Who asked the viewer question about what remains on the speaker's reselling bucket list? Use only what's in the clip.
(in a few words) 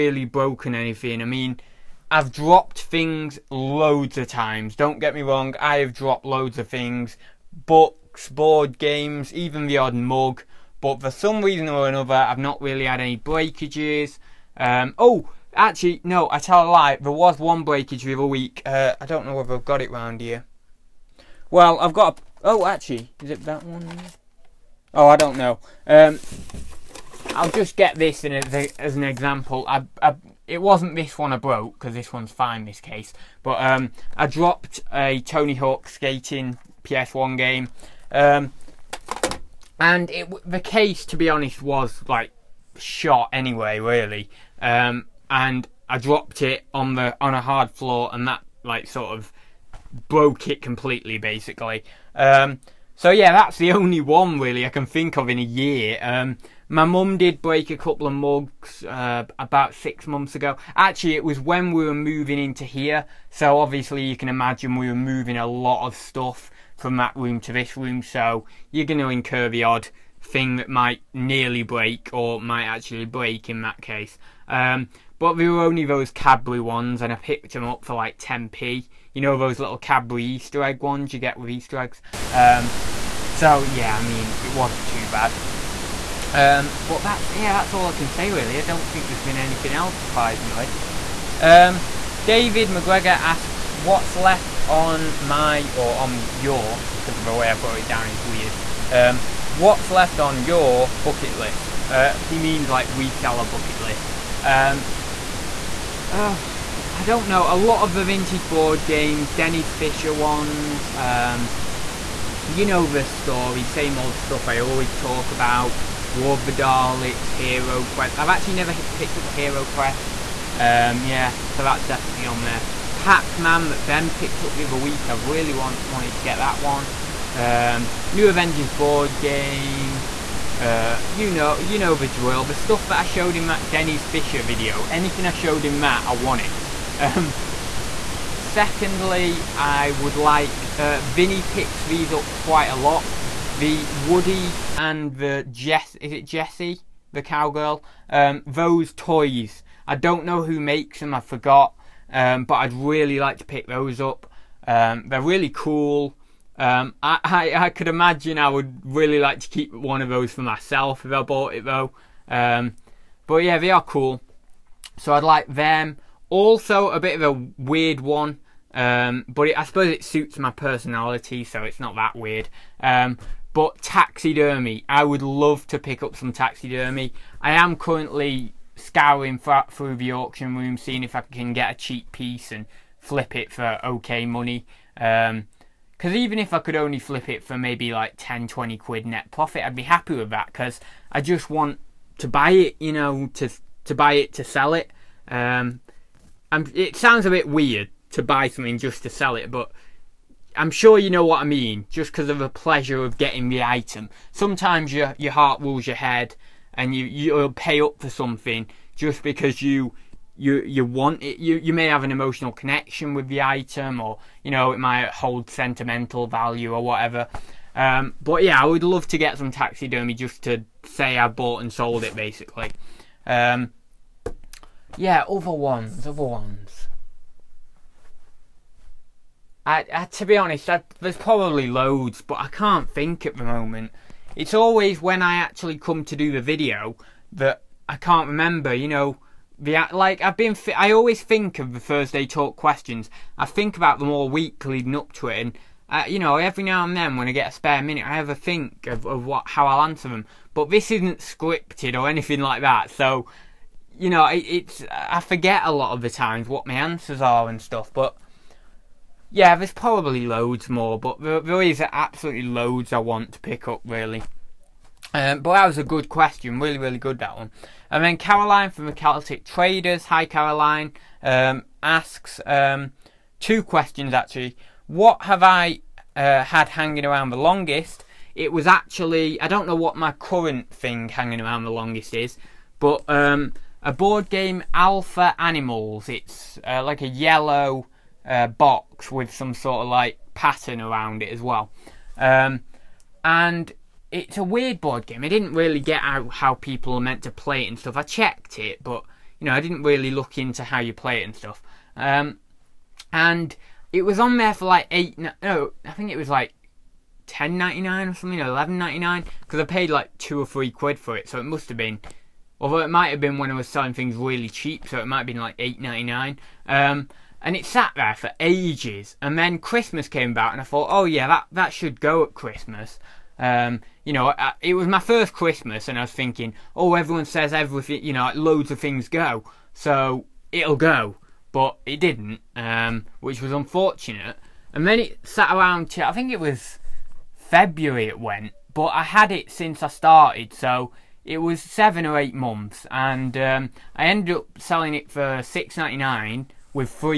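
David McGregor.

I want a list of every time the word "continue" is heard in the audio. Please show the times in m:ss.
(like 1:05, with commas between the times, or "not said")
not said.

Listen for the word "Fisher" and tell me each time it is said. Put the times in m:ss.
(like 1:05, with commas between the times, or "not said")
1:49, 2:14.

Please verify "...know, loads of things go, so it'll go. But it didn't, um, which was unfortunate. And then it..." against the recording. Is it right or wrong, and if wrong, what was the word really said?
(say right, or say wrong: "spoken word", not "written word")
right.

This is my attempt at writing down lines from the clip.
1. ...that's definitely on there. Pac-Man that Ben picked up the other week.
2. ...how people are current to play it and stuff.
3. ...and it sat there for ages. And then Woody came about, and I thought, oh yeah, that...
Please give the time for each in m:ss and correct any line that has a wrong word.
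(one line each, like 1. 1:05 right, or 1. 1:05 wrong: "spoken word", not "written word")
1. 2:01 right
2. 4:56 wrong: "meant", not "current"
3. 5:17 wrong: "Christmas", not "Woody".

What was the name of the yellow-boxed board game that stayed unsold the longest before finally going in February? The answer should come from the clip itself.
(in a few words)
Alpha Animals.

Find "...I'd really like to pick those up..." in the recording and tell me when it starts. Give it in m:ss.
2:32.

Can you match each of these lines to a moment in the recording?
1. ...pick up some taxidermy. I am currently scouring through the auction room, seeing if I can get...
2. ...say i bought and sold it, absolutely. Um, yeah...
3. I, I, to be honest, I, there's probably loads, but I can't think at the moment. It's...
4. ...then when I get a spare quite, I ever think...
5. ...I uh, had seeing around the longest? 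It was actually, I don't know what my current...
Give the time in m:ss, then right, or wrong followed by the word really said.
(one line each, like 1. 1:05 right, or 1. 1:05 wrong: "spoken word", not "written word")
1. 2:55 right
2. 3:40 wrong: "basically", not "absolutely"
3. 3:49 right
4. 4:06 wrong: "minute", not "quite"
5. 4:35 wrong: "hanging", not "seeing".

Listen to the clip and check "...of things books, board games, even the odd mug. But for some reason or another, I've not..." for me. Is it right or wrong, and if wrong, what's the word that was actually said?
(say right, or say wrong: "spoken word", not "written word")
right.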